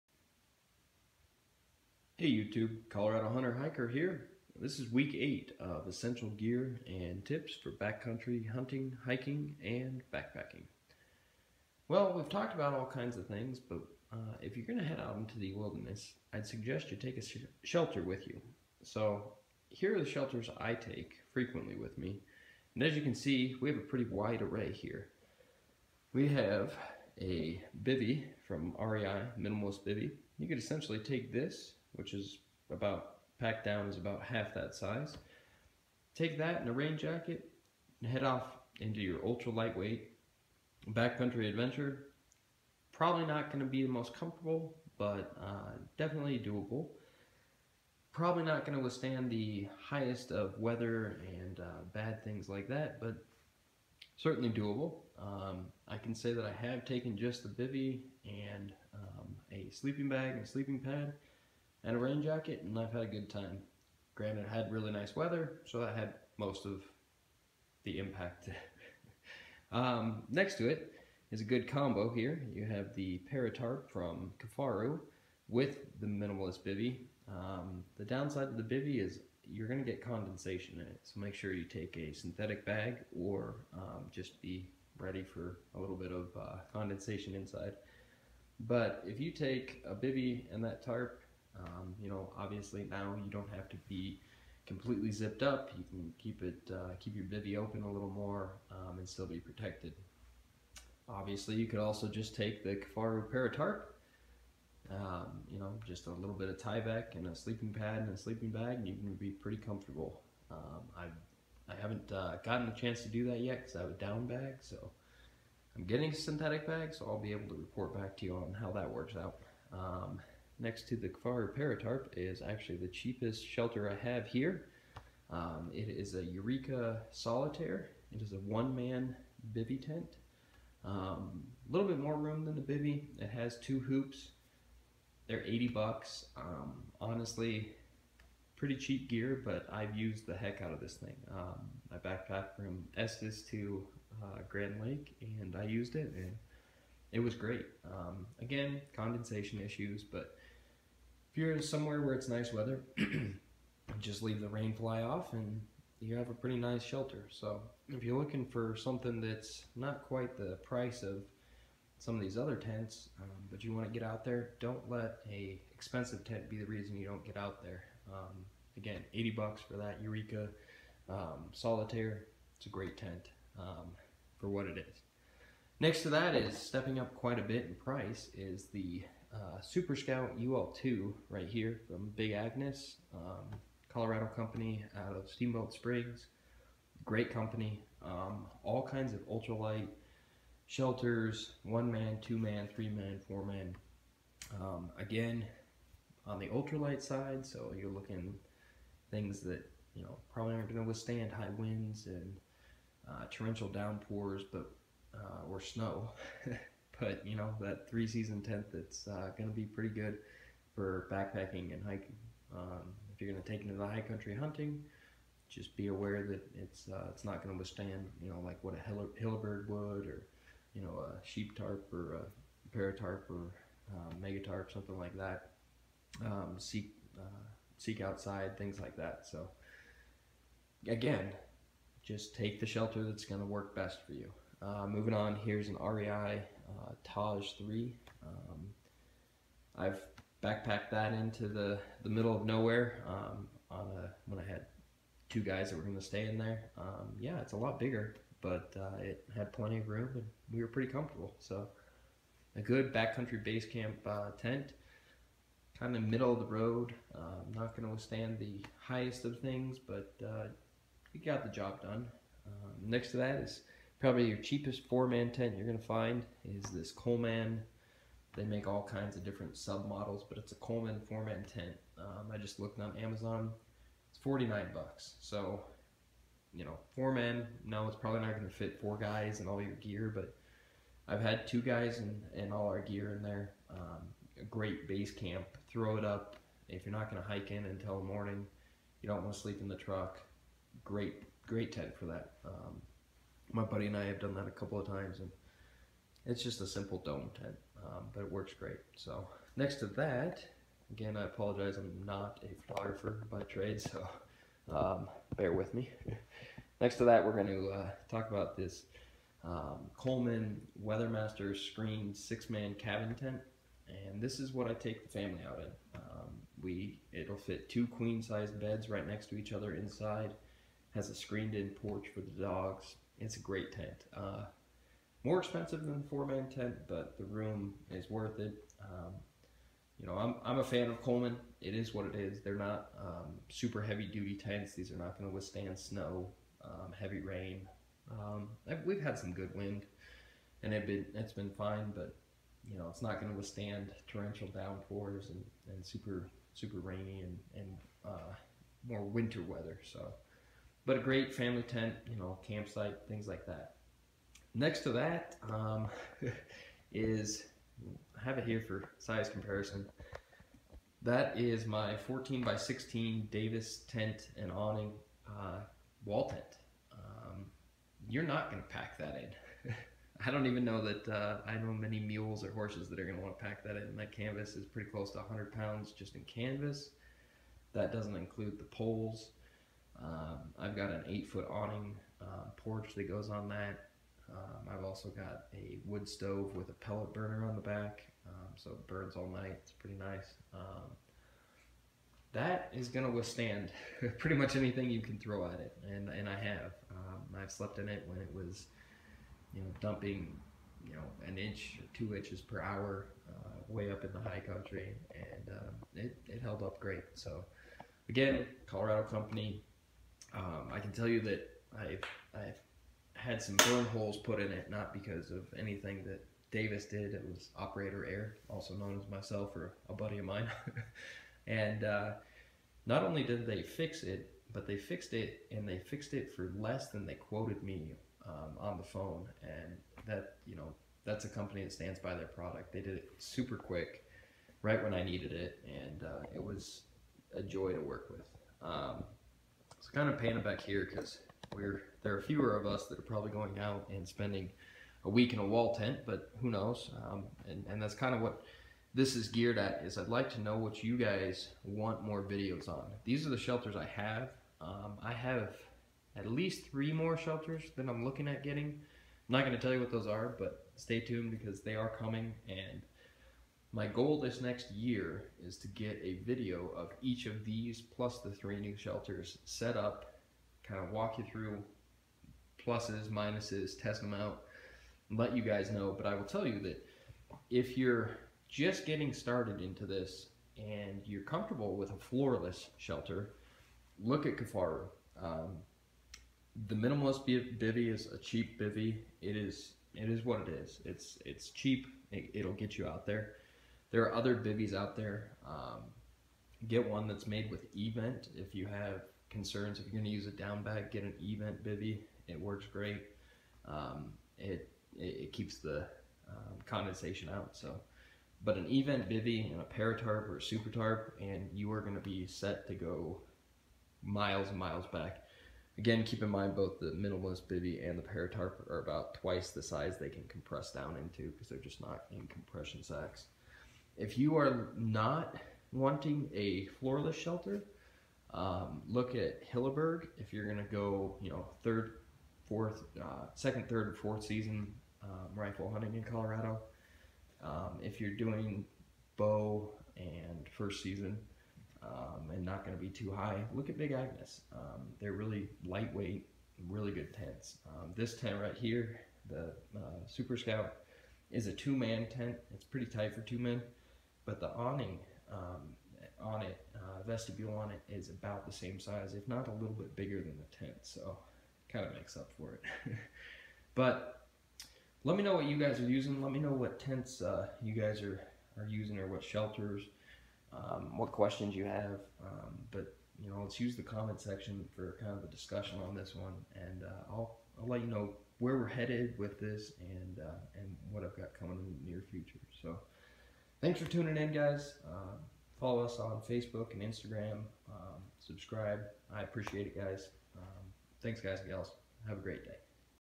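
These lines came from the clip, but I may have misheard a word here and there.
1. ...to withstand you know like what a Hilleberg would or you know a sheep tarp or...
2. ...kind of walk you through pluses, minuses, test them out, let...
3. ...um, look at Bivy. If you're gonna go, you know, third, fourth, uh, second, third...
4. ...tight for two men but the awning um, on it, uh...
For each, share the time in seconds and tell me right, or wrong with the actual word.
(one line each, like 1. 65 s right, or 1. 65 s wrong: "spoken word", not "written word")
1. 217 s right
2. 470 s right
3. 528 s wrong: "Hilleberg", not "Bivy"
4. 552 s right.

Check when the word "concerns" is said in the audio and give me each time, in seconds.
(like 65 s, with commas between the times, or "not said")
499 s.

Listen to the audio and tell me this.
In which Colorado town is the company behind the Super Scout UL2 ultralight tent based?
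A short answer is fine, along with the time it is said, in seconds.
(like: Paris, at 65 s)
Steamboat Springs, at 185 s.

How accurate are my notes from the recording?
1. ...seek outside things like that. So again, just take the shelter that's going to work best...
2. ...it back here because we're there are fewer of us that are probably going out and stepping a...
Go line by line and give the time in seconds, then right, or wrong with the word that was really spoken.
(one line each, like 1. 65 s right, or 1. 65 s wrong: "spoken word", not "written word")
1. 227 s right
2. 440 s wrong: "spending", not "stepping".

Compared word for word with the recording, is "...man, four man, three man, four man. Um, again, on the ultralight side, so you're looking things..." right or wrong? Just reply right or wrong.
wrong.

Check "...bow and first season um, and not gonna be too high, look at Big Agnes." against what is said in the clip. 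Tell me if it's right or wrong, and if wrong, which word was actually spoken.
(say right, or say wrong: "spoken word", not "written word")
right.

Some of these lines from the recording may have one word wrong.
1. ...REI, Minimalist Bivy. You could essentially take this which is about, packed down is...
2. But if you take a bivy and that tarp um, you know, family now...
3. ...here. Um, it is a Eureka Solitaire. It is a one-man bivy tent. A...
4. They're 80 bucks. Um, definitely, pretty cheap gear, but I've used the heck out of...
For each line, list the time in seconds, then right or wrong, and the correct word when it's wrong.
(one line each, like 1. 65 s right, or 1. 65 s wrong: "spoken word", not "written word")
1. 28 s right
2. 88 s wrong: "obviously", not "family"
3. 124 s right
4. 135 s wrong: "honestly", not "definitely".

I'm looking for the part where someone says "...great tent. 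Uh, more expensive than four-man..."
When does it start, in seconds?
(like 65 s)
323 s.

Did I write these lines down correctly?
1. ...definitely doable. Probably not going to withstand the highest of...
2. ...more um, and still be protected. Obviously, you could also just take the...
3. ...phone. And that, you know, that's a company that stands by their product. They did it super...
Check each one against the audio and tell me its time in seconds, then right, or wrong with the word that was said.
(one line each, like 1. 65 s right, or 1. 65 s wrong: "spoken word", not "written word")
1. 45 s right
2. 98 s right
3. 428 s right.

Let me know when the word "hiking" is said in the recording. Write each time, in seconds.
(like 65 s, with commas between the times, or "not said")
9 s, 211 s.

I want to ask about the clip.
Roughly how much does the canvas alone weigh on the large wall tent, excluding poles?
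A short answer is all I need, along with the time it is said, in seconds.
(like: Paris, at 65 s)
100 pounds, at 375 s.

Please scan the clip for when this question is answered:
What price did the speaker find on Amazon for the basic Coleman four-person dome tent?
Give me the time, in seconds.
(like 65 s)
274 s.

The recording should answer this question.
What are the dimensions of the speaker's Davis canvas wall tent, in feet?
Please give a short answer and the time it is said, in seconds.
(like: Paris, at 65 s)
14 by 16, at 361 s.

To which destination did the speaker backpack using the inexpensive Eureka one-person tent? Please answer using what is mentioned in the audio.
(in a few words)
Grand Lake.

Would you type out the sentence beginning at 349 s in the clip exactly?
So, but a great family tent, you know, campsite, things like that.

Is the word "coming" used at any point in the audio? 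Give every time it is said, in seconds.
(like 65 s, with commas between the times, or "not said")
461 s, 581 s.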